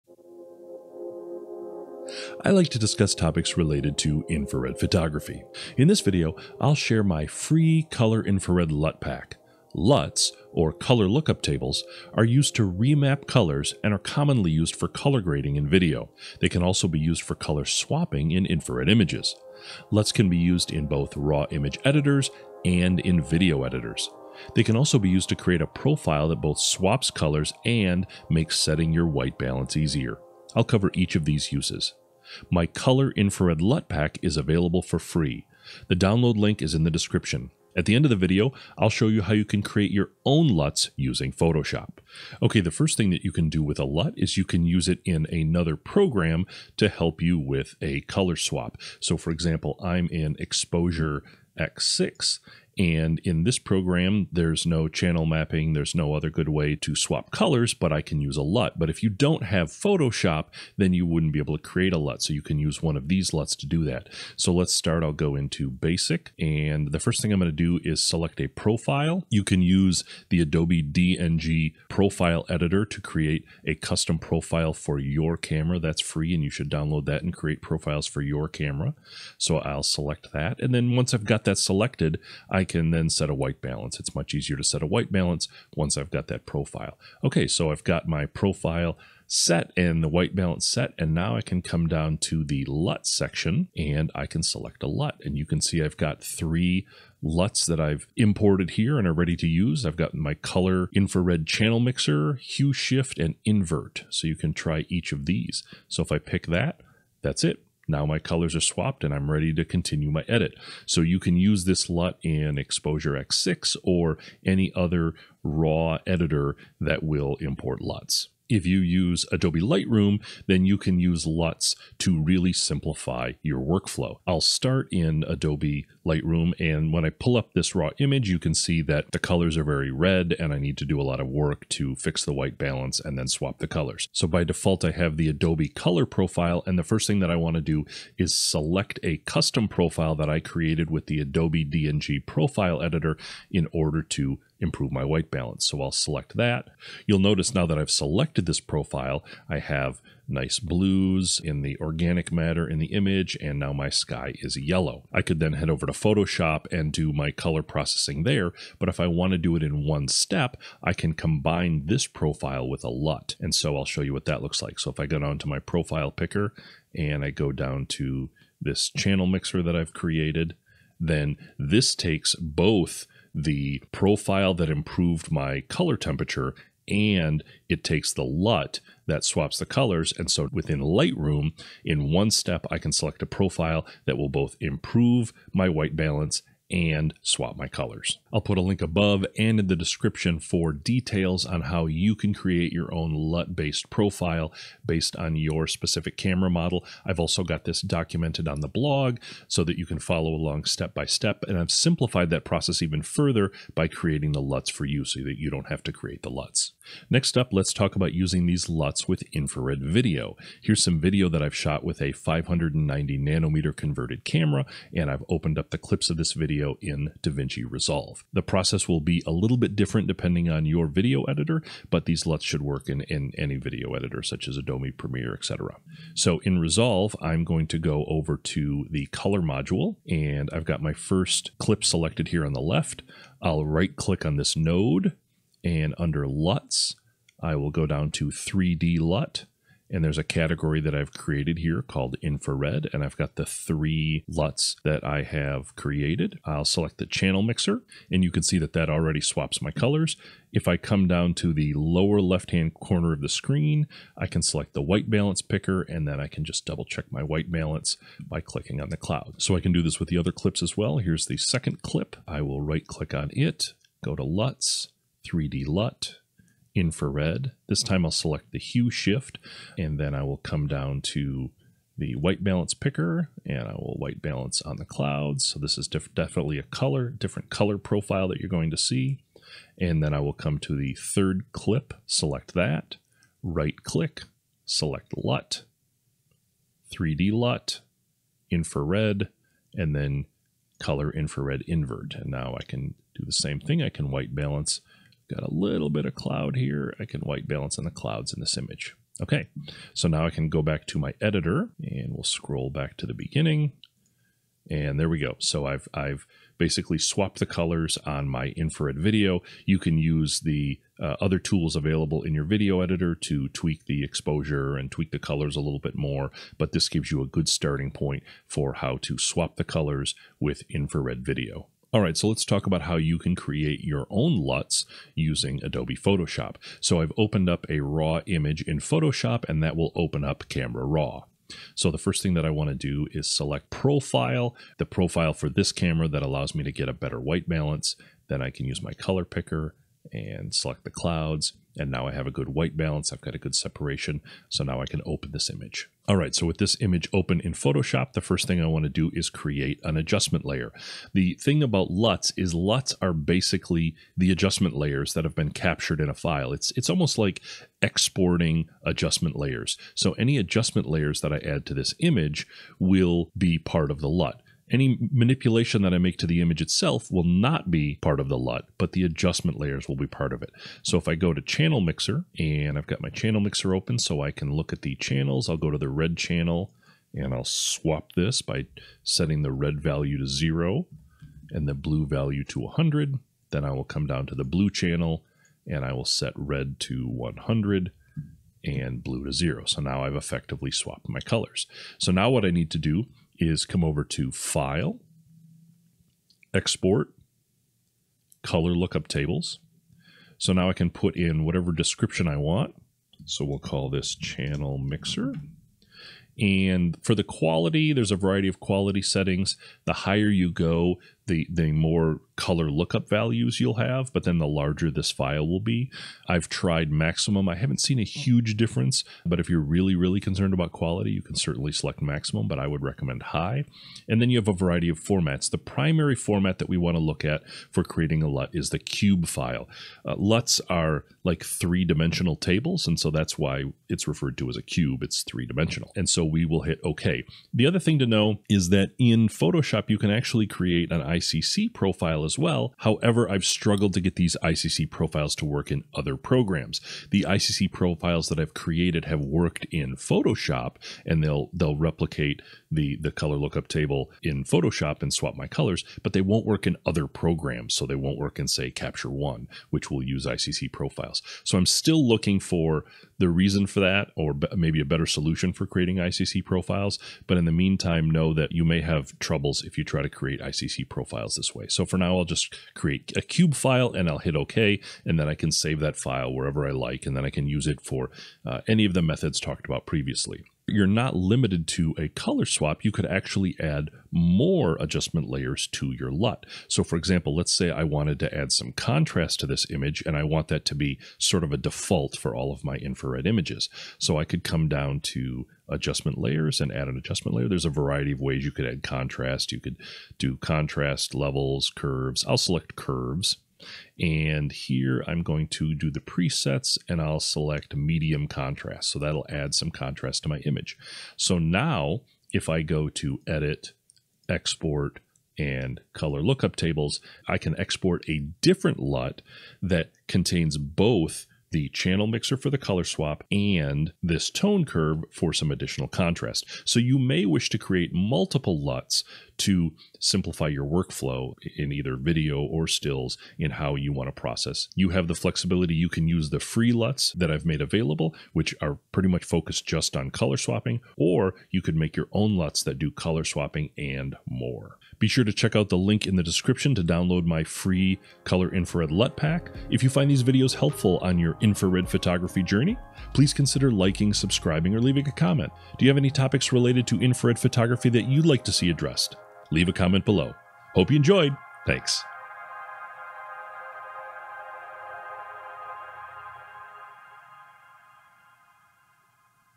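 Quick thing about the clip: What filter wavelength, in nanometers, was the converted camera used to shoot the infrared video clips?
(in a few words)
590.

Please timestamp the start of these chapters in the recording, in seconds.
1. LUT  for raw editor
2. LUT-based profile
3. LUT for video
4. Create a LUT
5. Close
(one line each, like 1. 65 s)
1. 42 s
2. 118 s
3. 206 s
4. 321 s
5. 544 s.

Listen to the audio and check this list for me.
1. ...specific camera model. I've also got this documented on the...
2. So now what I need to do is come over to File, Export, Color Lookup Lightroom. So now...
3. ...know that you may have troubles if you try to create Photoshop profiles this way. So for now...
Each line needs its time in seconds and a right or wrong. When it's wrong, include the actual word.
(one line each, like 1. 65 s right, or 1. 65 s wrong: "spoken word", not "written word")
1. 195 s right
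2. 391 s wrong: "Tables", not "Lightroom"
3. 468 s wrong: "ICC", not "Photoshop".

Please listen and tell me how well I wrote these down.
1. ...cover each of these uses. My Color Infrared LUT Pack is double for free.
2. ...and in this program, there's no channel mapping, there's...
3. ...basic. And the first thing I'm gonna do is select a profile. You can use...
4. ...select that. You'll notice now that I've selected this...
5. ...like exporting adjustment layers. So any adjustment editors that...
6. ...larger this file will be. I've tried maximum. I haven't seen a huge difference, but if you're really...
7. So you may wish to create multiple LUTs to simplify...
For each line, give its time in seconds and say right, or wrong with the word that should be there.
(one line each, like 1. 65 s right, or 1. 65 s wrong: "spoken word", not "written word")
1. 30 s wrong: "available", not "double"
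2. 52 s right
3. 65 s right
4. 145 s right
5. 357 s wrong: "layers", not "editors"
6. 414 s right
7. 526 s right.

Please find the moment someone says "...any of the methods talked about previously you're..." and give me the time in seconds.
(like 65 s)
478 s.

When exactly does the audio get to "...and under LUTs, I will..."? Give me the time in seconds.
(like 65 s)
235 s.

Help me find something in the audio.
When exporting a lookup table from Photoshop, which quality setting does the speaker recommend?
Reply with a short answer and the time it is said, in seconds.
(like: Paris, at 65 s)
High, at 423 s.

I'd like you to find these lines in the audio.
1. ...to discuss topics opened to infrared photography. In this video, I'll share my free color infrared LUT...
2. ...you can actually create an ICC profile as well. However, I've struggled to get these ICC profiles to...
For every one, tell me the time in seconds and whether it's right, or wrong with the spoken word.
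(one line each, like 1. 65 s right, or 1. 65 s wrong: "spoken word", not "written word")
1. 2 s wrong: "related", not "opened"
2. 439 s right.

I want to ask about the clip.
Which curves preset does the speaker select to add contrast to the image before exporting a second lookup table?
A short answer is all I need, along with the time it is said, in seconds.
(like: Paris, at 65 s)
Medium contrast, at 507 s.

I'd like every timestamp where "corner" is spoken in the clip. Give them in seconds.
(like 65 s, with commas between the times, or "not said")
252 s.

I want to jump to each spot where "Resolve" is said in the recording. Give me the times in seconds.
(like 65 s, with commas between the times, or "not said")
217 s, 226 s.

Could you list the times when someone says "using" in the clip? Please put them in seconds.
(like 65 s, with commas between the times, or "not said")
40 s, 208 s, 325 s.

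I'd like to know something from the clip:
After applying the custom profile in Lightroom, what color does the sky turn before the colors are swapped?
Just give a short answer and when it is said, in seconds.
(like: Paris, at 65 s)
Yellow, at 154 s.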